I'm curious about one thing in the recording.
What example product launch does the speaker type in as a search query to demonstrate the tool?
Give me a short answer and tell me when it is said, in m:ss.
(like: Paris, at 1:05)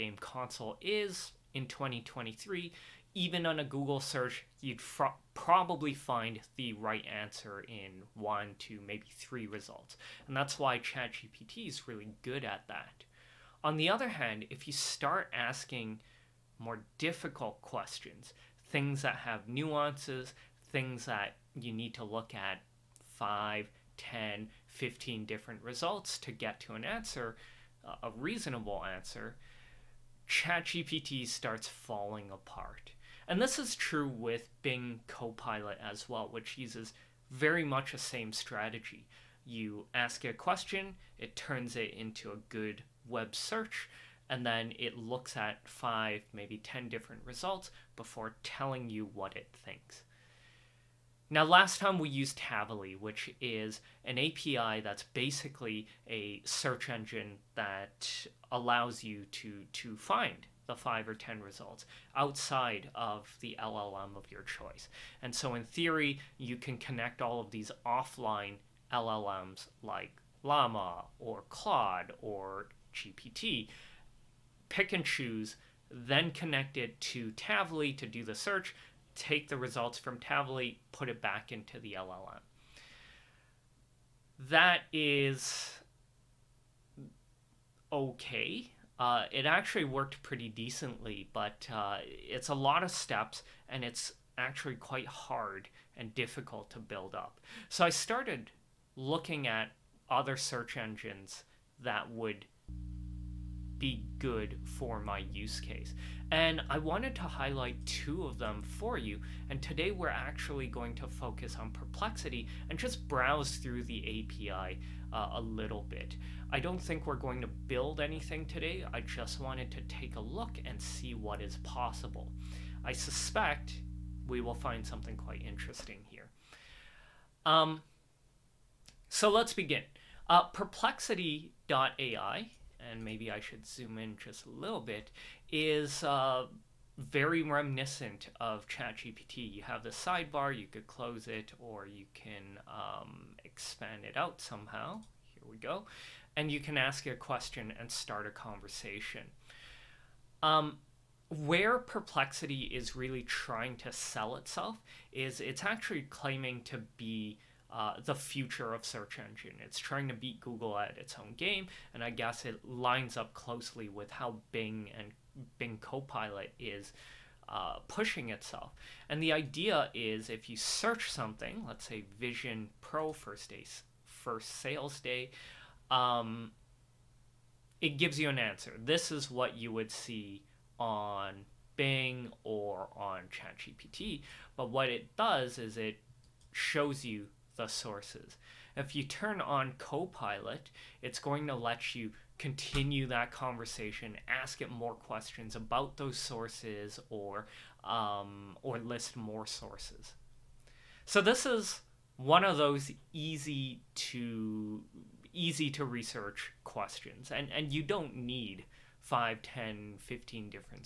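Vision Pro, at 2:52.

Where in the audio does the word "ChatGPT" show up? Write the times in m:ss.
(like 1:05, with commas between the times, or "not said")
0:10, 0:30, 2:18, 3:03.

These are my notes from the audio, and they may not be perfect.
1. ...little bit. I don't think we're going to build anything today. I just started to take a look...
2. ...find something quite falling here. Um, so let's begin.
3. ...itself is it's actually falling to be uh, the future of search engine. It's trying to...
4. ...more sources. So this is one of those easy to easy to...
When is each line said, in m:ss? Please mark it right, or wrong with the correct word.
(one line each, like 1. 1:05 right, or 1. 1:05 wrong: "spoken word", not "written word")
1. 1:55 wrong: "wanted", not "started"
2. 2:04 wrong: "interesting", not "falling"
3. 2:34 wrong: "claiming", not "falling"
4. 3:19 right.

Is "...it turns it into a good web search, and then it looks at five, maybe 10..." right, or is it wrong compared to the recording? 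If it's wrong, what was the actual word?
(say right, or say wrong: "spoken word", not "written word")
right.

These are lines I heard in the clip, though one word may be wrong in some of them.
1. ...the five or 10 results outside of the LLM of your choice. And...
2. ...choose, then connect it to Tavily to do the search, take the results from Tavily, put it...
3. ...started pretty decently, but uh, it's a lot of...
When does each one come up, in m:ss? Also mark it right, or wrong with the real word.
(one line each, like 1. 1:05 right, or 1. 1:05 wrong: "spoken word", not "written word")
1. 1:00 right
2. 1:15 right
3. 1:29 wrong: "worked", not "started".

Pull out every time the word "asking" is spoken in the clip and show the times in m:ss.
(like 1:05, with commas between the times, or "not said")
0:15.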